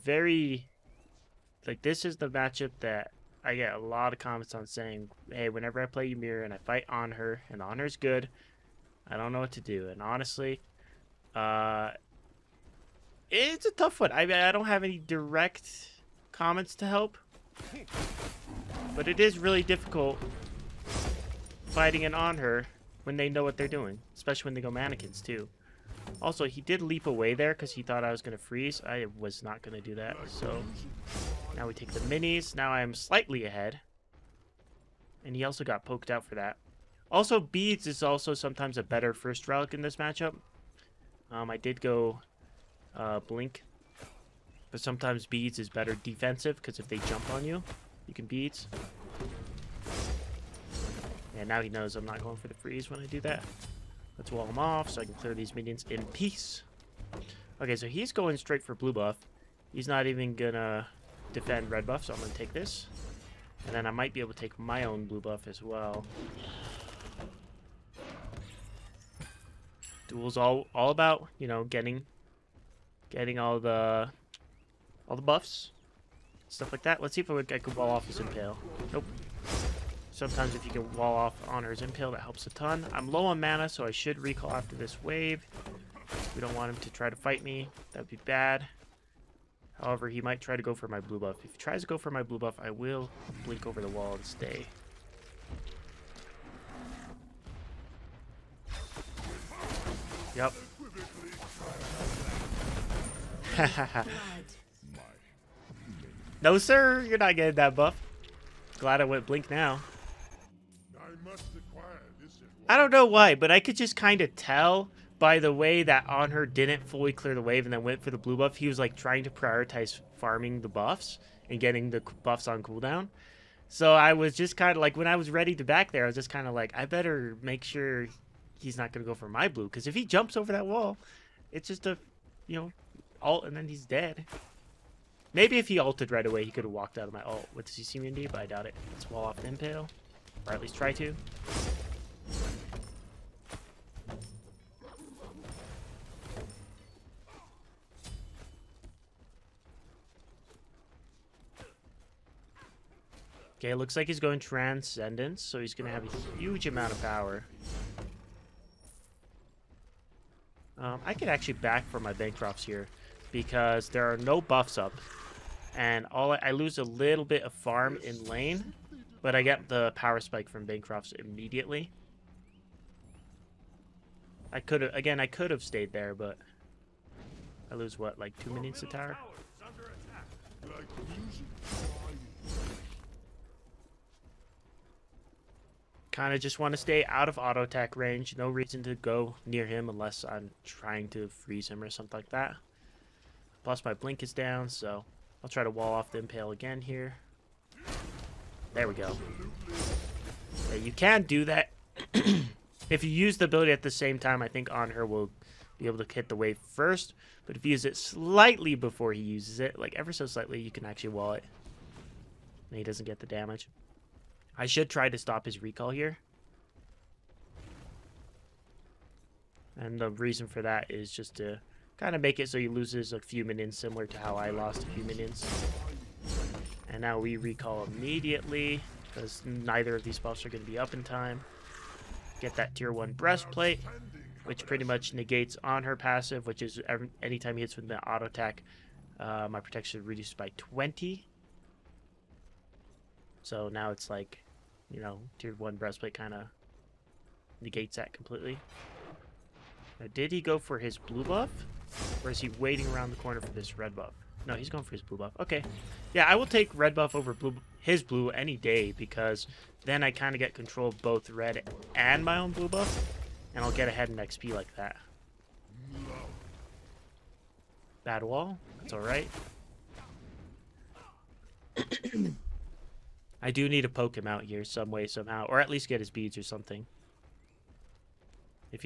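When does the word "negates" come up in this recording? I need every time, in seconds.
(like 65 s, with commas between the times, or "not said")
235 s, 247 s.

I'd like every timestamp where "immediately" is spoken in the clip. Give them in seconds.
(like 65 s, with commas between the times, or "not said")
171 s, 227 s.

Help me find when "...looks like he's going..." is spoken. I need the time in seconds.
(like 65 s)
153 s.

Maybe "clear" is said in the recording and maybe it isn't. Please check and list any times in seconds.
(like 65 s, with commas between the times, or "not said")
55 s, 117 s.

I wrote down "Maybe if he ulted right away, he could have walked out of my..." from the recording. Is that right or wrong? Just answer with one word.
right.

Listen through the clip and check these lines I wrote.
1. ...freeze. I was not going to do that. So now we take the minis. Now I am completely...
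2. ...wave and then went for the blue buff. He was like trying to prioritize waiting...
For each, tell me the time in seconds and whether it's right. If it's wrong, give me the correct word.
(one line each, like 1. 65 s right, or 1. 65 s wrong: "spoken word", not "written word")
1. 28 s wrong: "slightly", not "completely"
2. 117 s wrong: "farming", not "waiting".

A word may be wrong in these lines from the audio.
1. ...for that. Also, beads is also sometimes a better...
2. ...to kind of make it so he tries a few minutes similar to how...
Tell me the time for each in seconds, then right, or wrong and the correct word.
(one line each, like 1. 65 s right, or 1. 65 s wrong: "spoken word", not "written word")
1. 36 s right
2. 221 s wrong: "loses", not "tries".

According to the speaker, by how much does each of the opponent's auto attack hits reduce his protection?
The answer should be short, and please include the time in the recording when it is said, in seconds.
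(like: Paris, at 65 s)
20, at 240 s.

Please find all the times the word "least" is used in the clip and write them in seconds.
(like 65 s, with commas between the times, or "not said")
140 s, 275 s.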